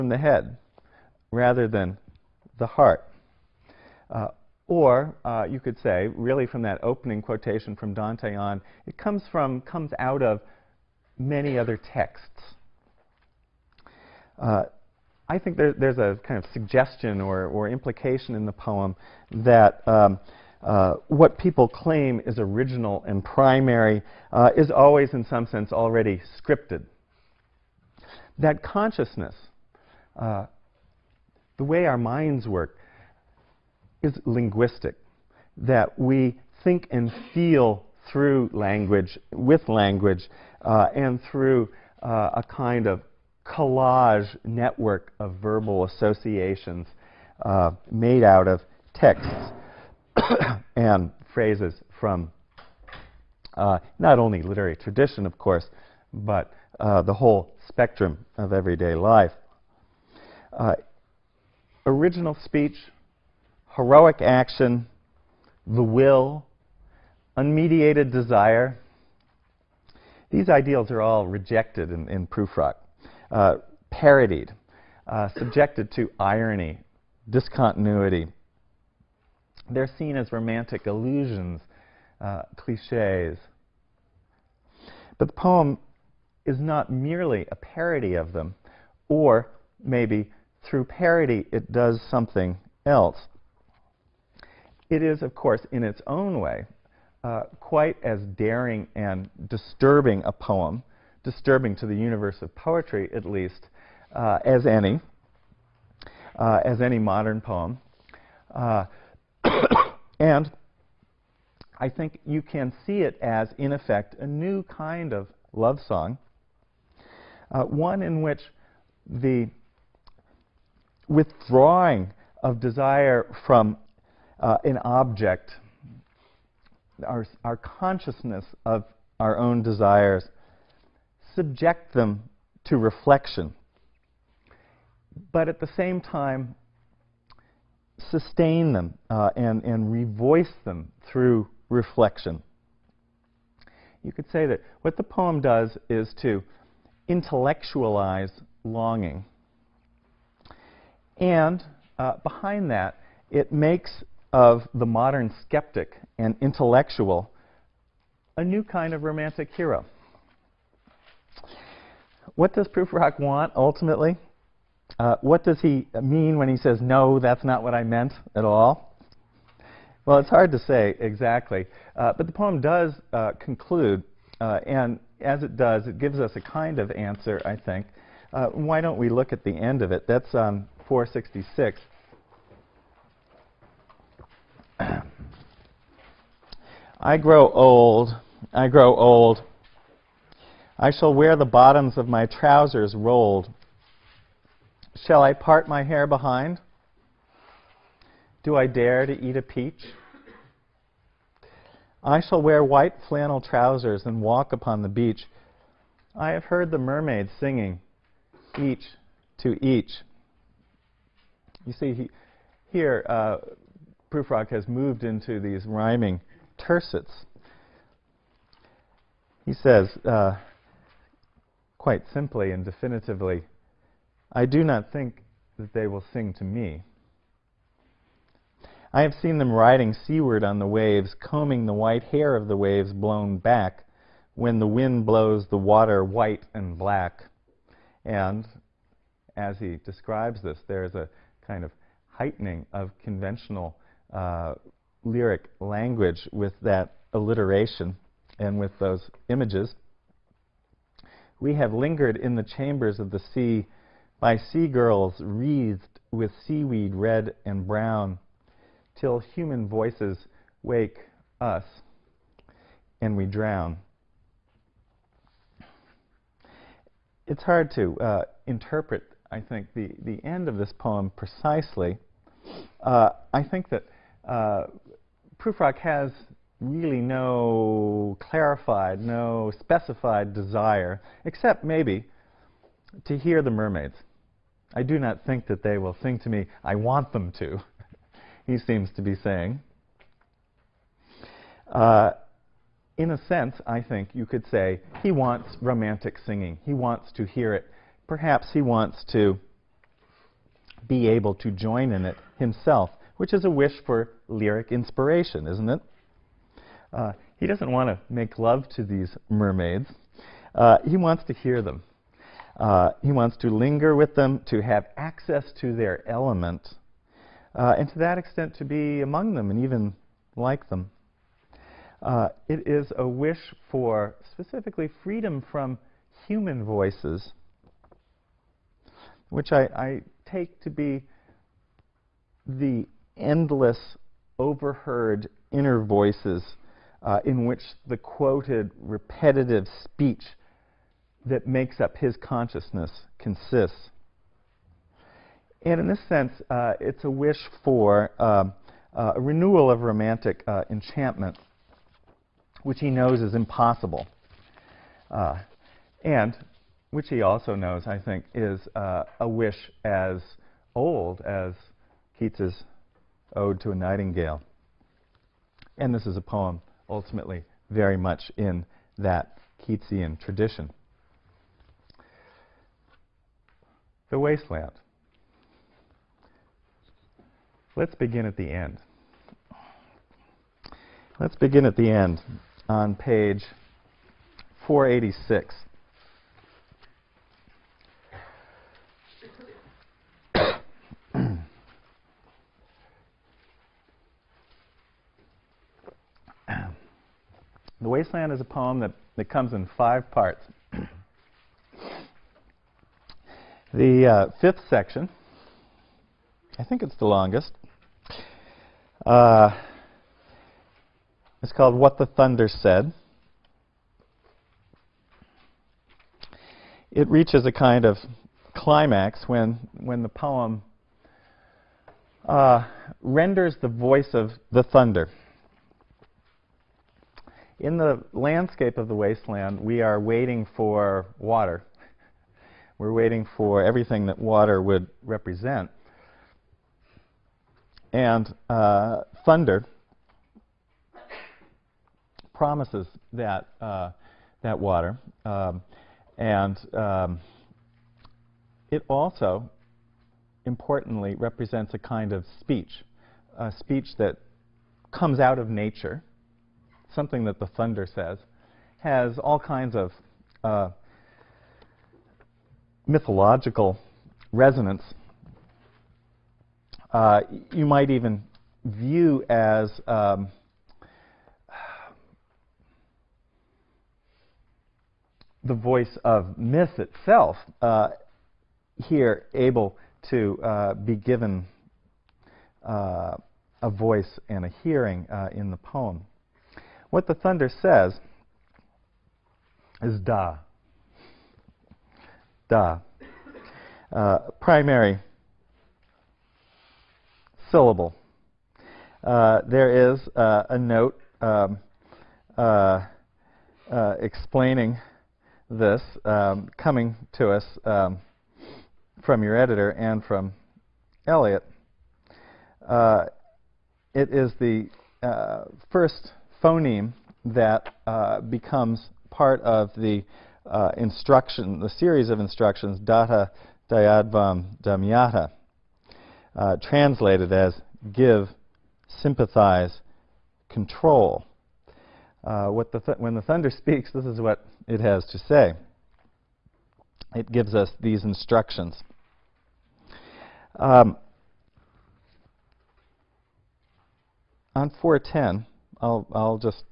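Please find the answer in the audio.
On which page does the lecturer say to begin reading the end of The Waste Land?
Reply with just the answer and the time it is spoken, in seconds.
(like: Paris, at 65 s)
486, at 384 s.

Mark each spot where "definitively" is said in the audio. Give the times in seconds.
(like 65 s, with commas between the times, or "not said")
222 s.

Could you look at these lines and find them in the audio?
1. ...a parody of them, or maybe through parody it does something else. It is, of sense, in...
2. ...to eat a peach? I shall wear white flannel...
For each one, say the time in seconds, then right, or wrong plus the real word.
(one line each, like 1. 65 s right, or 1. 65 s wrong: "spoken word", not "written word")
1. 87 s wrong: "course", not "sense"
2. 199 s right.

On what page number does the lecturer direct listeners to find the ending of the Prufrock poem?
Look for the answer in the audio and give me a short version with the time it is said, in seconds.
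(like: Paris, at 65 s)
466, at 180 s.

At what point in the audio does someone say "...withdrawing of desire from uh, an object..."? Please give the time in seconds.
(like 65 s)
121 s.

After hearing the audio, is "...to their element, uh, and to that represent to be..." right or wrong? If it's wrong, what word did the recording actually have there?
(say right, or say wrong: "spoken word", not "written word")
wrong: "extent", not "represent".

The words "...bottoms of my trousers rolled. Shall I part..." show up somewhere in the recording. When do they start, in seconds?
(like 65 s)
191 s.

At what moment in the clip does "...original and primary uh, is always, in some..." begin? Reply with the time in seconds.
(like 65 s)
22 s.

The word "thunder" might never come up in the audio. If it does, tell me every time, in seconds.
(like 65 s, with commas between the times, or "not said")
412 s, 424 s, 439 s, 457 s, 487 s, 533 s.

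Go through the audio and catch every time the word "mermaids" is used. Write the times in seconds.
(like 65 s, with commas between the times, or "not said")
206 s, 283 s, 309 s.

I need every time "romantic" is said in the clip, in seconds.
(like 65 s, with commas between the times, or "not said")
80 s, 159 s, 295 s, 349 s.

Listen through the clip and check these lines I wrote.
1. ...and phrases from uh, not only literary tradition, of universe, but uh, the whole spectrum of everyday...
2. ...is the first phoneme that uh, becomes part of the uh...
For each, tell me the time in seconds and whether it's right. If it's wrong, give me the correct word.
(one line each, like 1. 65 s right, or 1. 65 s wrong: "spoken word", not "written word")
1. 50 s wrong: "course", not "universe"
2. 514 s right.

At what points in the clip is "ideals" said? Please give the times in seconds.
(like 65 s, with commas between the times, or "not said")
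70 s.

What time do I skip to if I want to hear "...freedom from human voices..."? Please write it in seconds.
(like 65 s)
325 s.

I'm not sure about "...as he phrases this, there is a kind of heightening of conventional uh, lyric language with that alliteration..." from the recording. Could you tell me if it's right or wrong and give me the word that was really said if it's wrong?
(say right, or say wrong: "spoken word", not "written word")
wrong: "describes", not "phrases".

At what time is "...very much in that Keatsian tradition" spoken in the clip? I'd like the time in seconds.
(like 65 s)
367 s.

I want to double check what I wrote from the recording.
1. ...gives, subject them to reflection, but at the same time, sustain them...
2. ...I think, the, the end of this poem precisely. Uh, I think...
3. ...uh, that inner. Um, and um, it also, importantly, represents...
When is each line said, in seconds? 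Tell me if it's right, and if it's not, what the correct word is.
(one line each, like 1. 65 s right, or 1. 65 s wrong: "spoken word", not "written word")
1. 129 s wrong: "desires", not "gives"
2. 269 s right
3. 443 s wrong: "water", not "inner".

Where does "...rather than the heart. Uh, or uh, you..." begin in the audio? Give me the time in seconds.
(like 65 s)
1 s.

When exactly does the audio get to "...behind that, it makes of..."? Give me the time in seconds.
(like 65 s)
152 s.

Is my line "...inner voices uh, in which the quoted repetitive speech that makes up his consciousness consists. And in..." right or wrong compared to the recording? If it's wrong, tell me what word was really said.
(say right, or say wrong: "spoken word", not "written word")
right.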